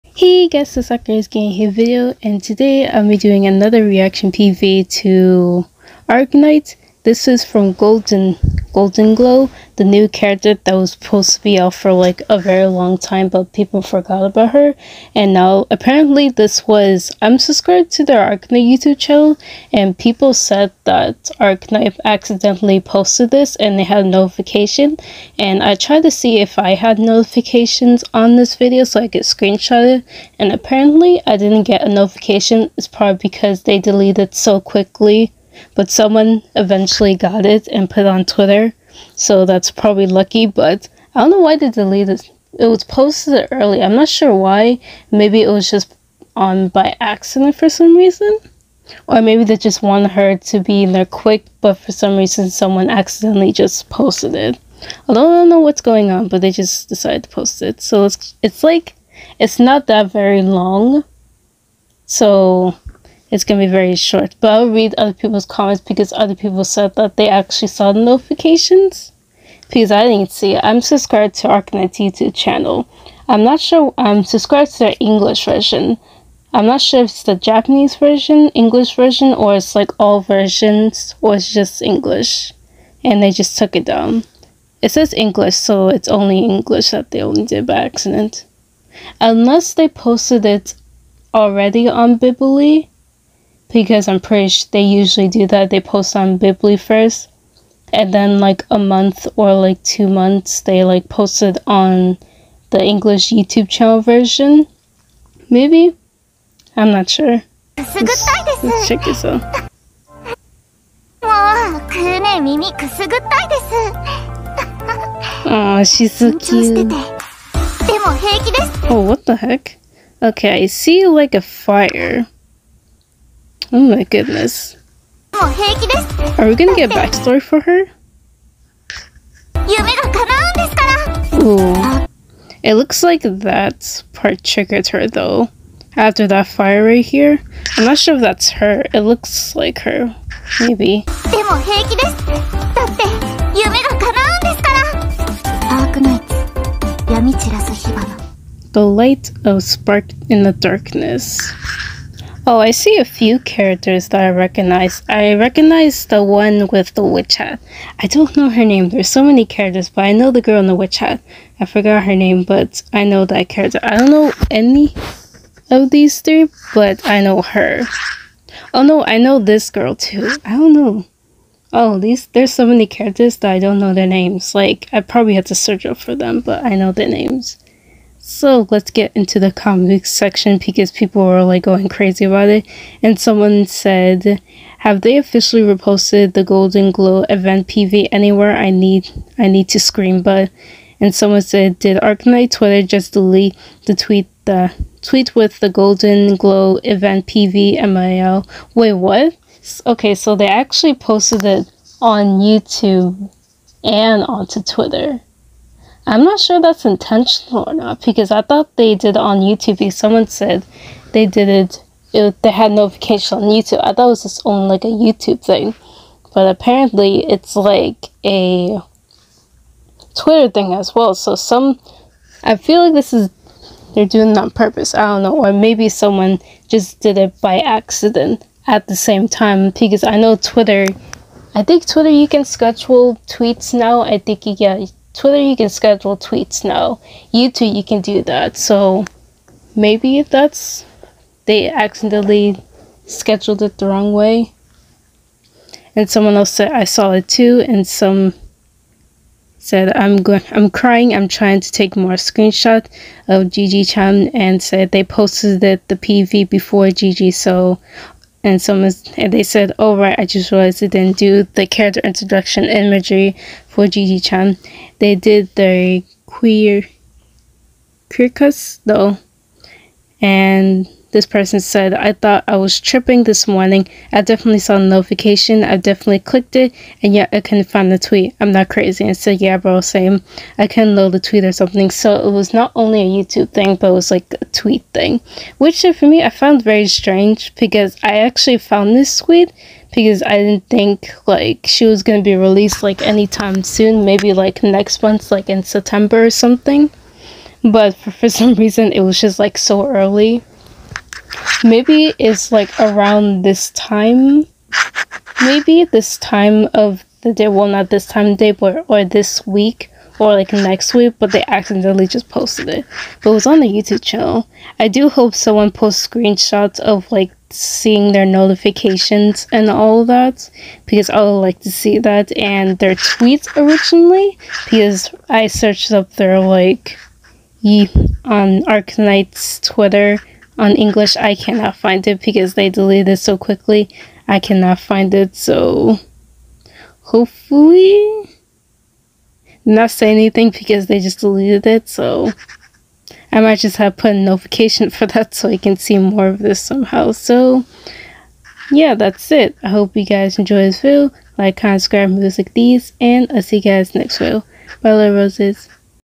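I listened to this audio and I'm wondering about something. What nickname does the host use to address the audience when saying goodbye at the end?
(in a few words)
little roses.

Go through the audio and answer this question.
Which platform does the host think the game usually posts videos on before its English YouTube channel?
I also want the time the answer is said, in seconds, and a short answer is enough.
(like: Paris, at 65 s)
Bilibili, at 92 s.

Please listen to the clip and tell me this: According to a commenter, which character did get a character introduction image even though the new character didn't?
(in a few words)
Quercus.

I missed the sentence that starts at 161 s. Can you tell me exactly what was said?
I forgot her name, but I know that character.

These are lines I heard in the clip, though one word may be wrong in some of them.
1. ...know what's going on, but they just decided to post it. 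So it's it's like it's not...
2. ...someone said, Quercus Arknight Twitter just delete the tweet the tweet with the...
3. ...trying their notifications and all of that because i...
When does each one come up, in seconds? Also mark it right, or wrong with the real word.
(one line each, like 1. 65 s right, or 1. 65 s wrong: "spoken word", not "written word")
1. 55 s right
2. 191 s wrong: "Did", not "Quercus"
3. 317 s wrong: "seeing", not "trying".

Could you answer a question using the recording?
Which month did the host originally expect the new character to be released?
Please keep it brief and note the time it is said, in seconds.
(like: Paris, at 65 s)
September, at 295 s.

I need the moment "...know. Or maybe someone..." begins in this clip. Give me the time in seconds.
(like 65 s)
225 s.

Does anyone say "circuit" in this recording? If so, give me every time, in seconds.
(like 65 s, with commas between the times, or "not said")
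not said.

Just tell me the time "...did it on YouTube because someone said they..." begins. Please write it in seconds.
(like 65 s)
208 s.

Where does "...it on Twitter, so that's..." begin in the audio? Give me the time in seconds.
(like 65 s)
38 s.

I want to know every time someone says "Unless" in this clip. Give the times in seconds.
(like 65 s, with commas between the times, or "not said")
89 s.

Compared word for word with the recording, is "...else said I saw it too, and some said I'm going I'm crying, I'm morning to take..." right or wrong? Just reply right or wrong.
wrong.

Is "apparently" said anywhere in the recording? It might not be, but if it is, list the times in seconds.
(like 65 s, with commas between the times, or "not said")
15 s, 30 s, 216 s.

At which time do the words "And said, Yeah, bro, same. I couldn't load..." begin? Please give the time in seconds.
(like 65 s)
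279 s.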